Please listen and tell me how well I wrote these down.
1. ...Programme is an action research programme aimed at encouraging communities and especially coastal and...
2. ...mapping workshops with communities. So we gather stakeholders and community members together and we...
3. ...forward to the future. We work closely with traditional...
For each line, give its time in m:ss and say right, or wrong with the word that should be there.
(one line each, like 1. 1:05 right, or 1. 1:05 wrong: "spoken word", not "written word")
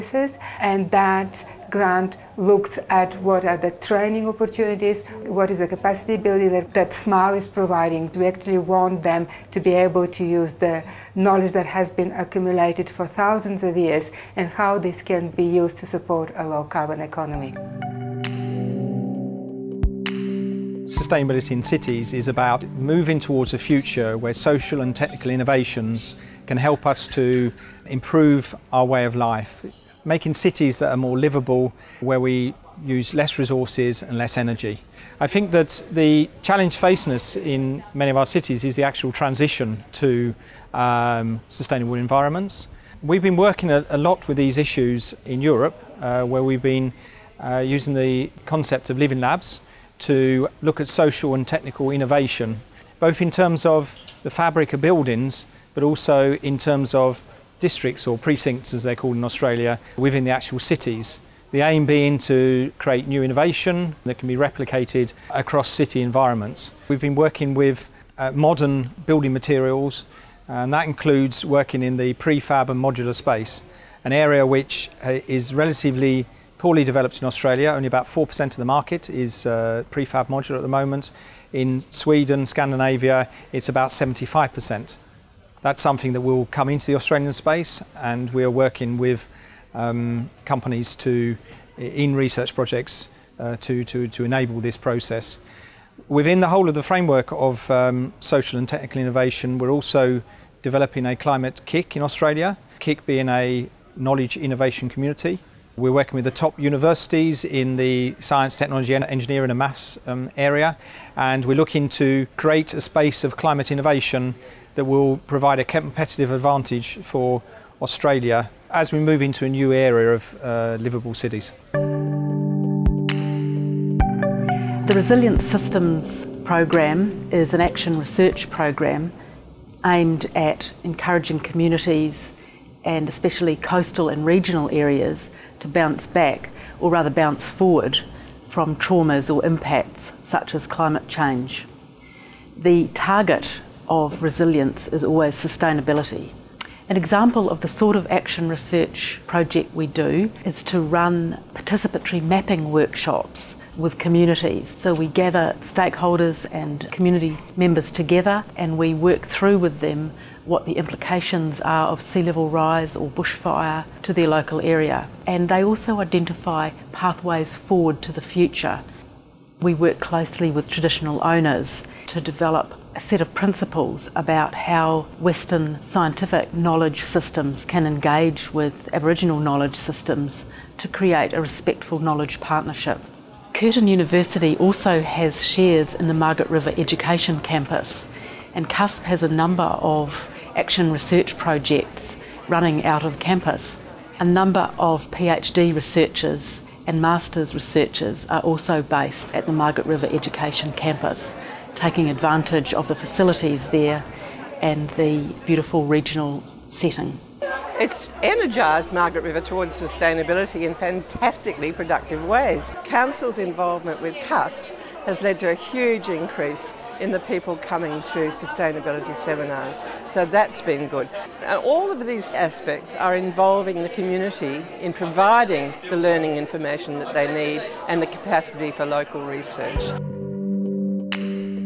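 1. 2:06 right
2. 2:32 right
3. 2:47 right.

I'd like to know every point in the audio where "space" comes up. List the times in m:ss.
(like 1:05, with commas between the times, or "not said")
1:13, 1:27, 1:52.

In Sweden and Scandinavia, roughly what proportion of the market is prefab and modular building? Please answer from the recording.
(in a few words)
75%.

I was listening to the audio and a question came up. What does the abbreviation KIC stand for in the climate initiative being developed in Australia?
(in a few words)
knowledge innovation community.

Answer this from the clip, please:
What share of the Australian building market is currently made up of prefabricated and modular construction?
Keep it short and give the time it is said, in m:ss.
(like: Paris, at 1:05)
4%, at 1:17.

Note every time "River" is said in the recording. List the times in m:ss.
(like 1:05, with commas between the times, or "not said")
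3:06, 3:19, 3:29.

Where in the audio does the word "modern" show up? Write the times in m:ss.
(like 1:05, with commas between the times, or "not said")
1:08.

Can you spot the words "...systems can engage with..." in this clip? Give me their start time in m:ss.
2:57.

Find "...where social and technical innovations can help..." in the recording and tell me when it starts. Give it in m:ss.
0:24.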